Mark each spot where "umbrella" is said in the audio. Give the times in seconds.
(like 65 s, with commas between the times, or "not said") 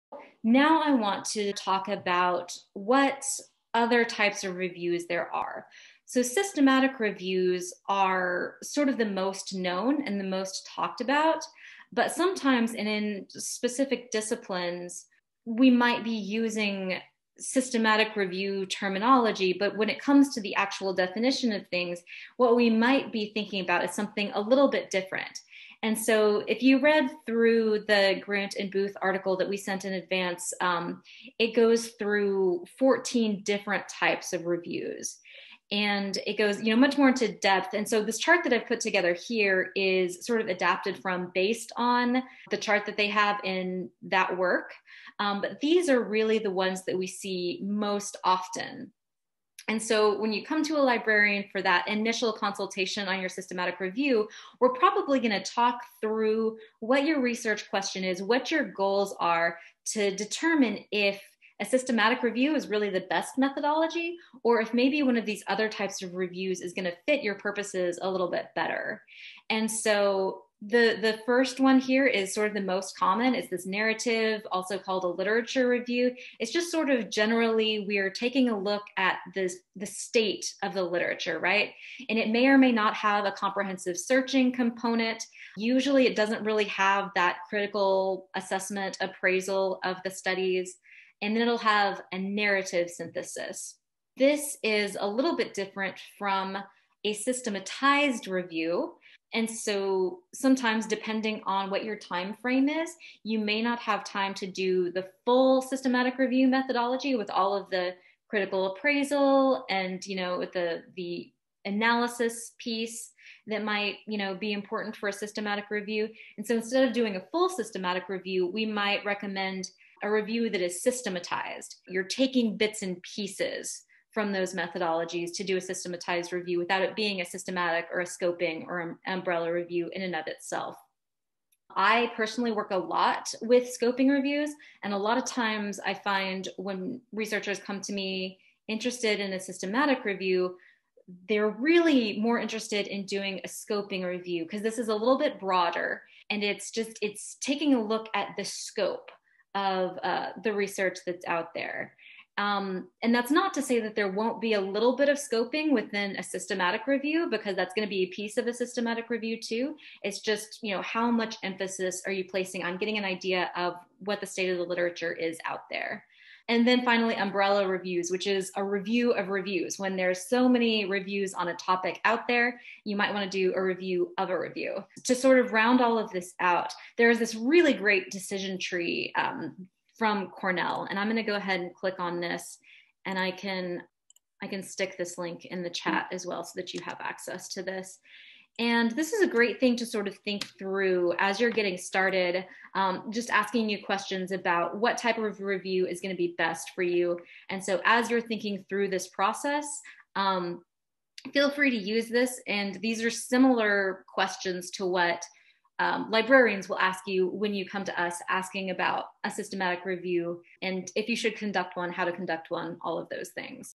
129 s, 167 s.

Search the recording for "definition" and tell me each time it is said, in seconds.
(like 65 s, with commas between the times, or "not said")
20 s.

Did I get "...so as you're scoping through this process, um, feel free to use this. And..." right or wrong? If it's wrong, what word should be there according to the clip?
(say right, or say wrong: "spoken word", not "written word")
wrong: "thinking", not "scoping".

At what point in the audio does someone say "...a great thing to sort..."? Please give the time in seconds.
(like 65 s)
189 s.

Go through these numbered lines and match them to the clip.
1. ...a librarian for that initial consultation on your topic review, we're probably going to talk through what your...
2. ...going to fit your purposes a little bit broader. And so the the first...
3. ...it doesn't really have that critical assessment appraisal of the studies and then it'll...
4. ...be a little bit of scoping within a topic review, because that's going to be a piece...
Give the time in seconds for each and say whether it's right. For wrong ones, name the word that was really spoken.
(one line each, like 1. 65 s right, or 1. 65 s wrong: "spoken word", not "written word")
1. 50 s wrong: "systematic", not "topic"
2. 66 s wrong: "better", not "broader"
3. 86 s right
4. 154 s wrong: "systematic", not "topic".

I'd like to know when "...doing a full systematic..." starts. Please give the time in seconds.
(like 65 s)
116 s.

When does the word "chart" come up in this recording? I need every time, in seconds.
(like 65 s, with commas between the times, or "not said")
38 s, 42 s.